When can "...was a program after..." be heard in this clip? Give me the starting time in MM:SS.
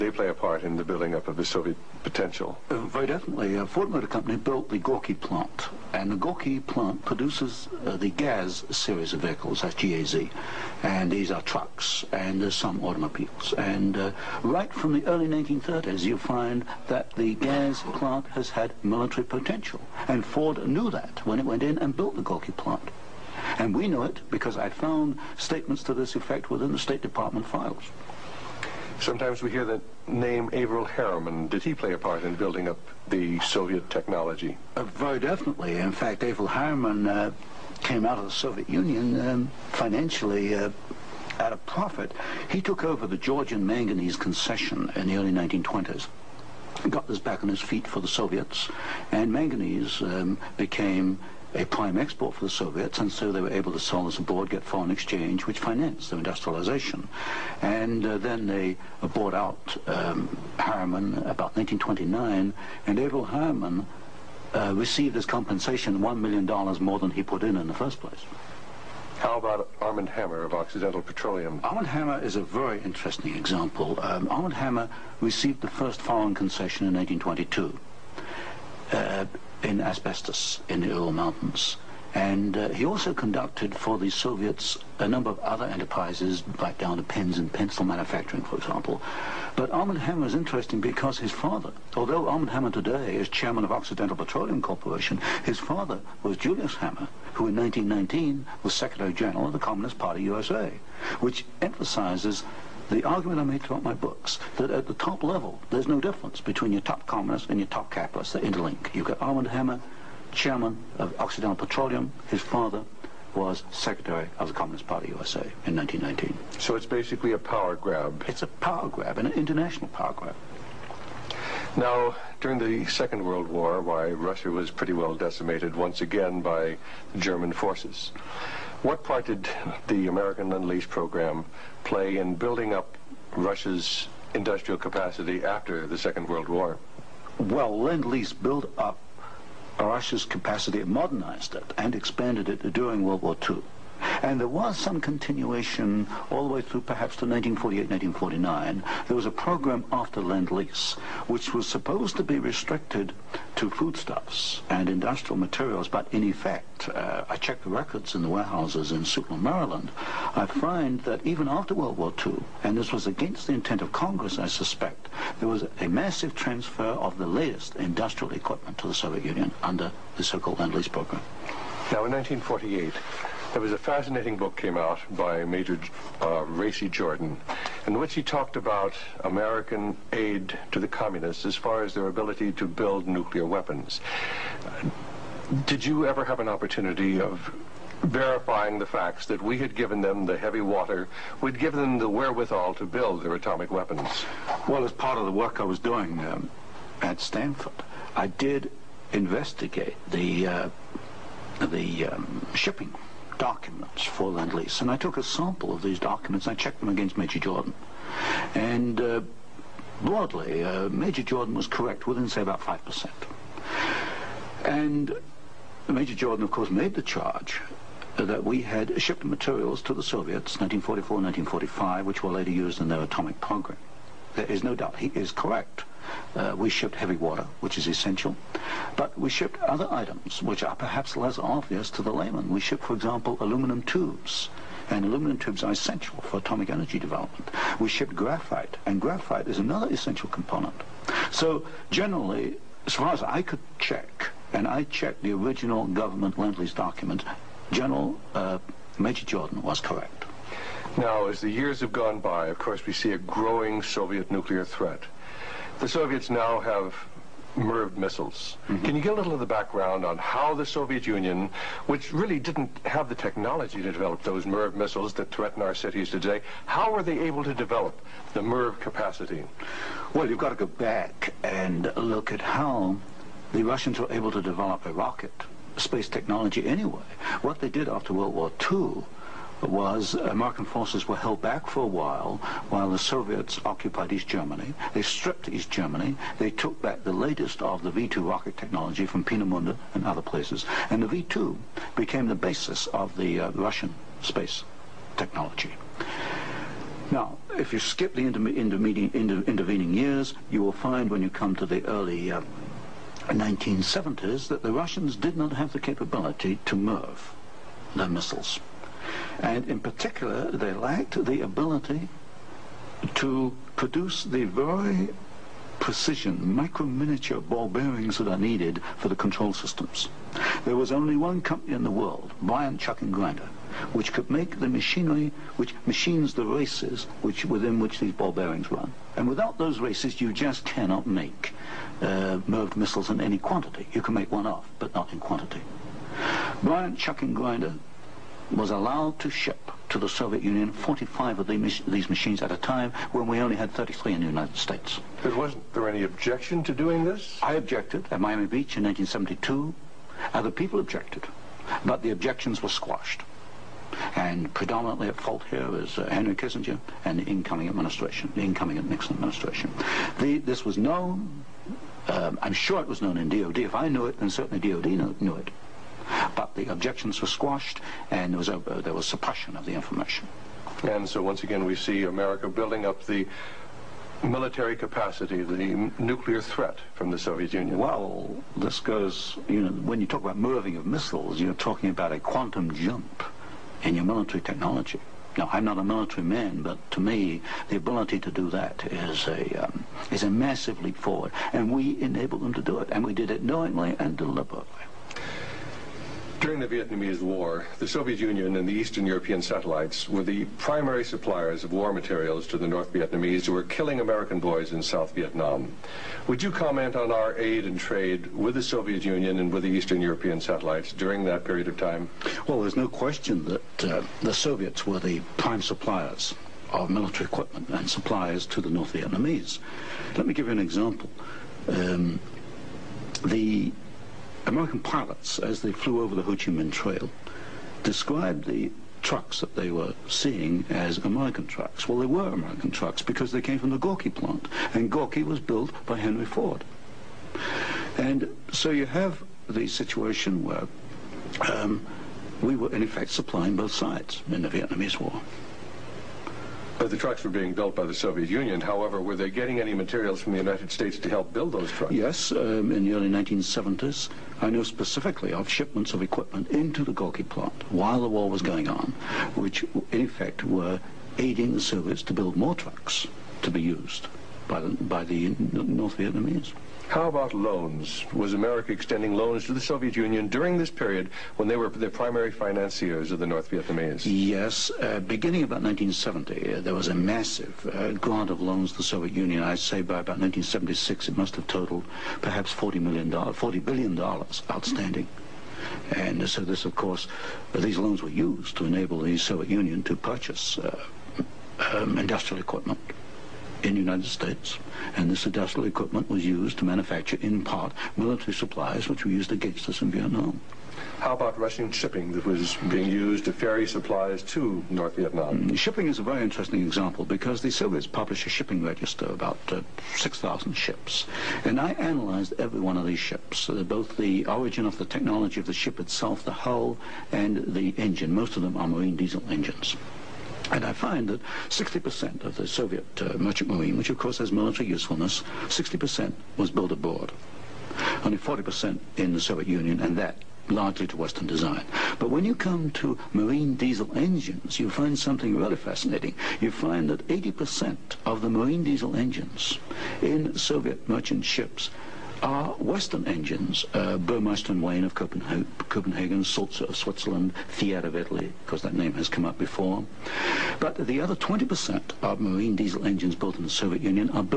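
02:29.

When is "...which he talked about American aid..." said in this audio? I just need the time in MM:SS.
02:57.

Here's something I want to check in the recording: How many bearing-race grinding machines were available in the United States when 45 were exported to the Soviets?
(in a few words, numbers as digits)
33.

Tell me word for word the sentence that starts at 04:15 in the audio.
The Soviets now have MIRV missiles.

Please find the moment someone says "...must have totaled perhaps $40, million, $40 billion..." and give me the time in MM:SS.
08:01.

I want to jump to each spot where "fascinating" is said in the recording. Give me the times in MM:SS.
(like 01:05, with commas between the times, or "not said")
02:53, 08:55.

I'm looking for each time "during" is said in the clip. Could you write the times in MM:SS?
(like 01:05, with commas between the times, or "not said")
02:02, 02:22, 06:36, 06:50, 07:50.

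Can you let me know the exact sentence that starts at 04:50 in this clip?
And the V-2 became the basis of the uh, Russian space technology.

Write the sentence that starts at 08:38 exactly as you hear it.
Most of them are marine diesel engines.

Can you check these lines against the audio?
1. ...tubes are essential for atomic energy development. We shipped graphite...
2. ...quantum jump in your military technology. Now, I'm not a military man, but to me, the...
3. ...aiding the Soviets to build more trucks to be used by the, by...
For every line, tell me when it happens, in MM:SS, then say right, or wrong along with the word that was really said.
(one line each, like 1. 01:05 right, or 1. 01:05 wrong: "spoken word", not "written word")
1. 03:55 right
2. 06:22 right
3. 07:41 right.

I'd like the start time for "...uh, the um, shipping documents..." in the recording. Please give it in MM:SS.
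03:20.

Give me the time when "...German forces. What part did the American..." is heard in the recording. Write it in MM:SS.
02:07.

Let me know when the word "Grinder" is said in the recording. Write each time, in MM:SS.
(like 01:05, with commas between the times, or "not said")
05:23, 05:37.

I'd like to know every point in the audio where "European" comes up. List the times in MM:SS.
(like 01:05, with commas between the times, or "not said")
06:39, 06:50.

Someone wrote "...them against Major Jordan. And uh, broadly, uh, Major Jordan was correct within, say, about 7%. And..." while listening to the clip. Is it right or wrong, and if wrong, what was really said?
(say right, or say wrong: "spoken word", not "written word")
wrong: "5", not "7".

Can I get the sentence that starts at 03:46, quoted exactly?
Uh, we shipped heavy water, which is essential, but we shipped other items which are perhaps less obvious to the layman.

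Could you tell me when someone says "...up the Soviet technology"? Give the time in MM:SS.
00:32.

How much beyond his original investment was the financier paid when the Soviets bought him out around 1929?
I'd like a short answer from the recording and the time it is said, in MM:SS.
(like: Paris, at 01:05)
$1 million, at 01:05.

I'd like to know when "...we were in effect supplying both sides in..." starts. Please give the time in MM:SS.
07:22.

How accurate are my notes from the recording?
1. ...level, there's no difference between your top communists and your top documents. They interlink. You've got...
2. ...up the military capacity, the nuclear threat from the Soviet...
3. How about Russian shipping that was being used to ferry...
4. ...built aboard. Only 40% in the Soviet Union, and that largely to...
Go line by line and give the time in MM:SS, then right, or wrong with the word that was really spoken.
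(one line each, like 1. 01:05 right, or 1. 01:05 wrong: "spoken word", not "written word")
1. 01:45 wrong: "capitalists", not "documents"
2. 06:12 right
3. 08:20 right
4. 08:46 right.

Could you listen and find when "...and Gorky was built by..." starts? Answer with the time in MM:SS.
07:14.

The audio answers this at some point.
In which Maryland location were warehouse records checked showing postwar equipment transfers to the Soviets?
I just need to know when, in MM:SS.
02:39.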